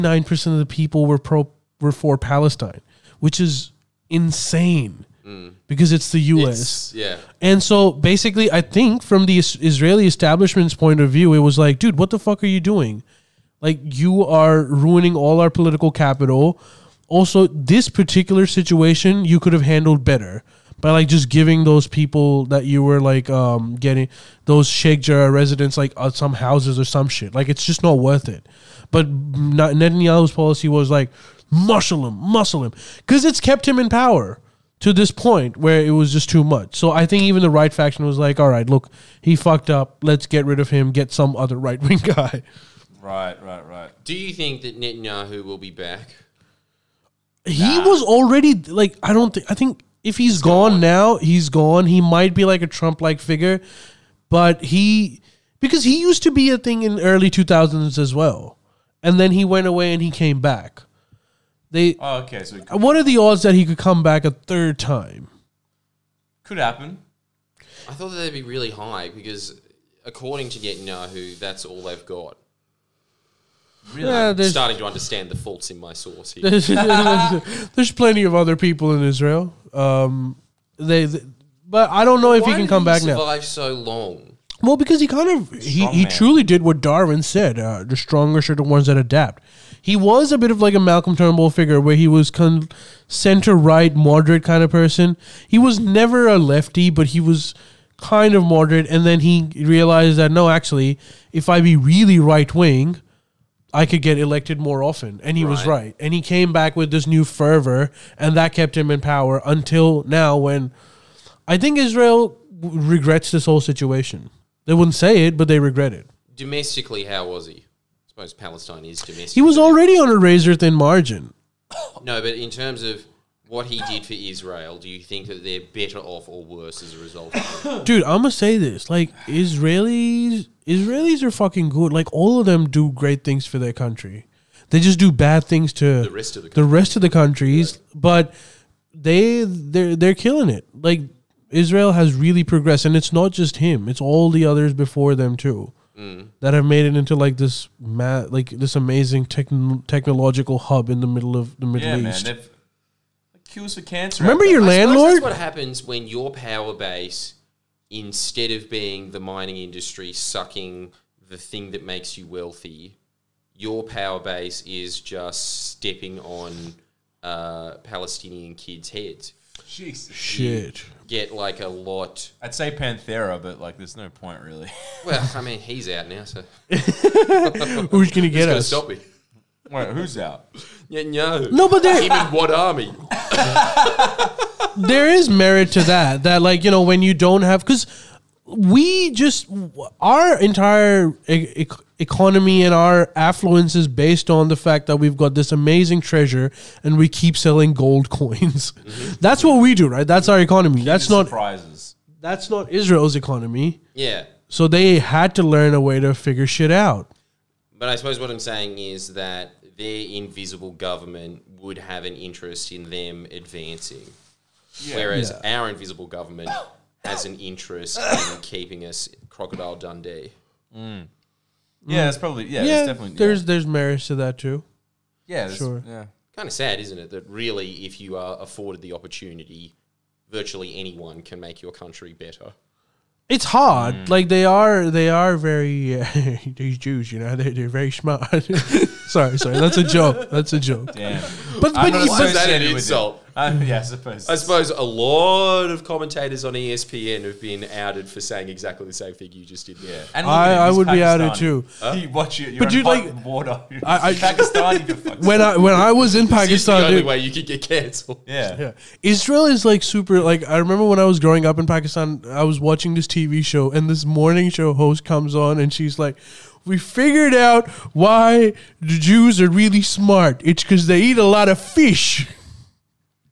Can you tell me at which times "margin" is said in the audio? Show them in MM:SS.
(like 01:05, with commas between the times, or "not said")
02:00.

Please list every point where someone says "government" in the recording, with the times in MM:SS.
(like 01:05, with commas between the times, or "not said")
03:30, 03:36.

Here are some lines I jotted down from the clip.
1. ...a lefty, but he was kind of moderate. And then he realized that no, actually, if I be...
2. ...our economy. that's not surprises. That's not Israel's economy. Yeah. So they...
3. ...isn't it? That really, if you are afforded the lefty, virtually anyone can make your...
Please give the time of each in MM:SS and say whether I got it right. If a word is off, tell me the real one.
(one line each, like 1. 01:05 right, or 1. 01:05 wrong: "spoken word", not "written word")
1. 01:36 right
2. 03:20 right
3. 03:46 wrong: "opportunity", not "lefty".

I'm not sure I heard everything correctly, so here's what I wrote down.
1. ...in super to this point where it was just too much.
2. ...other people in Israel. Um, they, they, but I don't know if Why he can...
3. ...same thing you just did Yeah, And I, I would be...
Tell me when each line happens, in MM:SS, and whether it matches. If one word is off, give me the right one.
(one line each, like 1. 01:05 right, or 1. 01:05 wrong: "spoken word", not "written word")
1. 00:33 wrong: "power", not "super"
2. 01:18 right
3. 04:08 right.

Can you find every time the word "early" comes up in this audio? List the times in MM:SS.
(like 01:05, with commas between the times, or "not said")
00:57.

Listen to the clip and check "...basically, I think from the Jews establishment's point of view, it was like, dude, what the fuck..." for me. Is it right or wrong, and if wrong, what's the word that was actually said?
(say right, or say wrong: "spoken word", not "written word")
wrong: "Israeli", not "Jews".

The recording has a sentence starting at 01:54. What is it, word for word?
They wouldn't say it, but they regret it.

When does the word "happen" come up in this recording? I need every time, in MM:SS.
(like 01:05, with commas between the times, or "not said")
01:06, 02:35.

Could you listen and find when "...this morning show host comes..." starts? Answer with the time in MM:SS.
04:23.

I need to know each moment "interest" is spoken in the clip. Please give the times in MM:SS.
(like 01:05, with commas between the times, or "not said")
03:32, 03:37.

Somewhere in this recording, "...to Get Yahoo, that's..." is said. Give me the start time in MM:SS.
01:10.